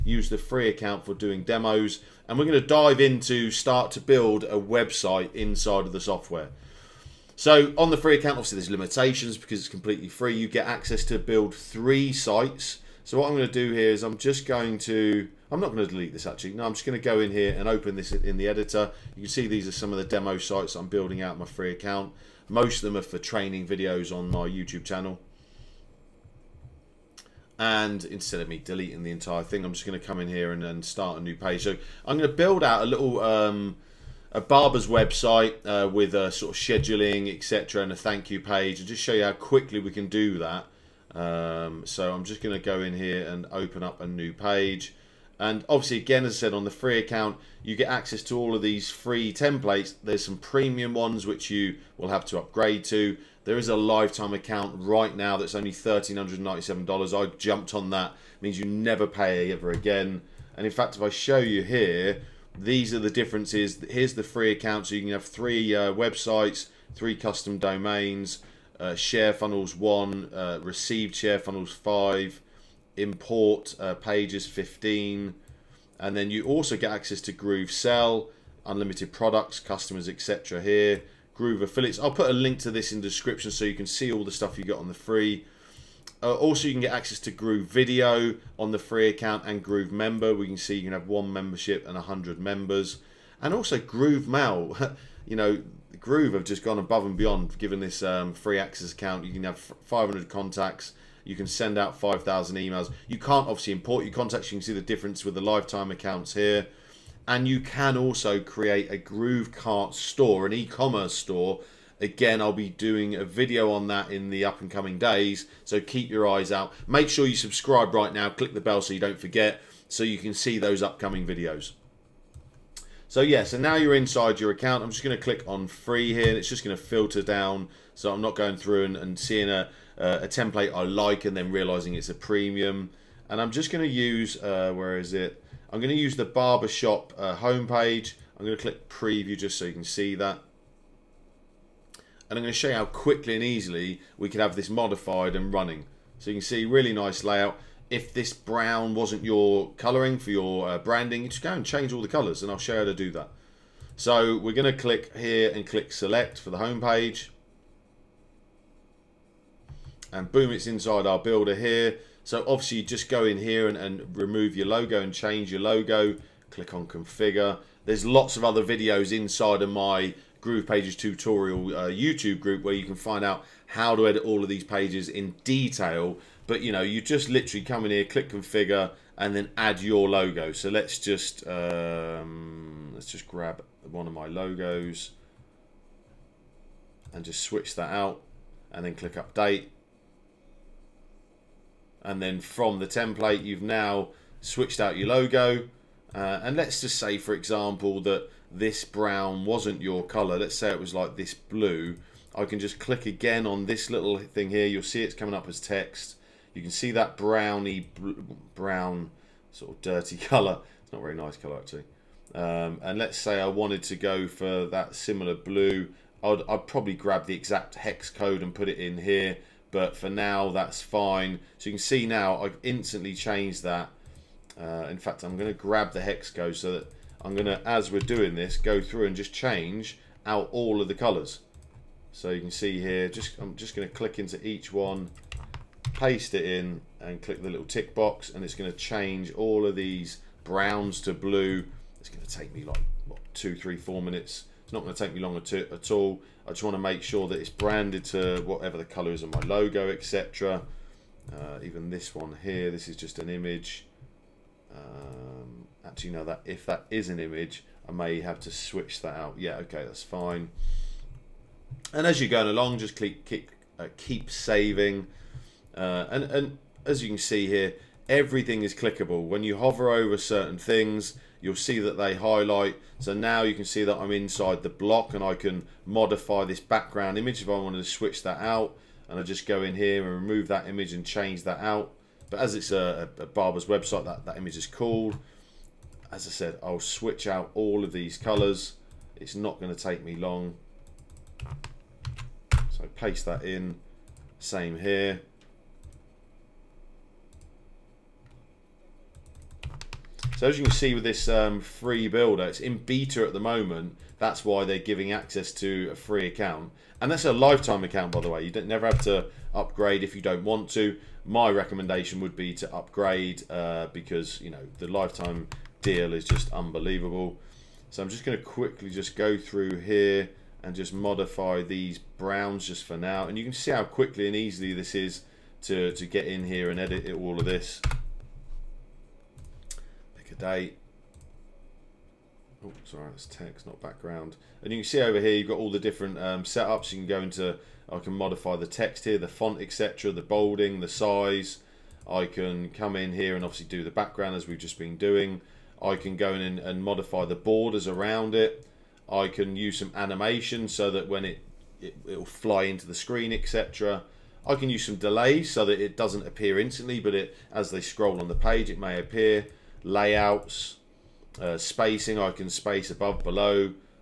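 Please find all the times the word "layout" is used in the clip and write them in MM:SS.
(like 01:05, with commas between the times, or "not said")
02:27, 05:59.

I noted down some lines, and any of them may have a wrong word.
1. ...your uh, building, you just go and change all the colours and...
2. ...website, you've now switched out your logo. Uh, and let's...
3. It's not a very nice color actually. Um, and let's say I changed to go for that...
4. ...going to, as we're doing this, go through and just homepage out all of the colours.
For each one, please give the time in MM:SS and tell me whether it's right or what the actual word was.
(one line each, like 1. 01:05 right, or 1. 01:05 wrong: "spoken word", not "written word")
1. 02:30 wrong: "branding", not "building"
2. 03:12 wrong: "template", not "website"
3. 03:30 wrong: "wanted", not "changed"
4. 03:47 wrong: "change", not "homepage".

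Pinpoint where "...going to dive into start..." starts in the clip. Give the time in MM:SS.
00:02.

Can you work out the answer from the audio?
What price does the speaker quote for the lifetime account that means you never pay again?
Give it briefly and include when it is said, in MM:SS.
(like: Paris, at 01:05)
$1,397, at 00:55.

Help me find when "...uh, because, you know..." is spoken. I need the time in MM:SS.
05:13.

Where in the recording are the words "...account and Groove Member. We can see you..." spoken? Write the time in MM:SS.
01:29.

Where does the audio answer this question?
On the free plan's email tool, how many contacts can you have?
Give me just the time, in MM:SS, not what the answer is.
01:39.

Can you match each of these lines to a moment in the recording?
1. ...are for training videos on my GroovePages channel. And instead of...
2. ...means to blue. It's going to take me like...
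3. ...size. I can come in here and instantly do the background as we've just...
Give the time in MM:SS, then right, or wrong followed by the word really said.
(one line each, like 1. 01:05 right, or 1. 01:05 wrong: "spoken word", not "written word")
1. 00:22 wrong: "YouTube", not "GroovePages"
2. 04:00 wrong: "browns", not "means"
3. 05:40 wrong: "obviously", not "instantly".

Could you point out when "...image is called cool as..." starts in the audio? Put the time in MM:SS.
04:44.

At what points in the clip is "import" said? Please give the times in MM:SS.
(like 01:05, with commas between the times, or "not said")
01:12, 01:43.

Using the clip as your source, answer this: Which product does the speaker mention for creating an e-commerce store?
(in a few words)
GrooveKart.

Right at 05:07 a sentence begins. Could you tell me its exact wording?
And that's a lifetime account, by the way.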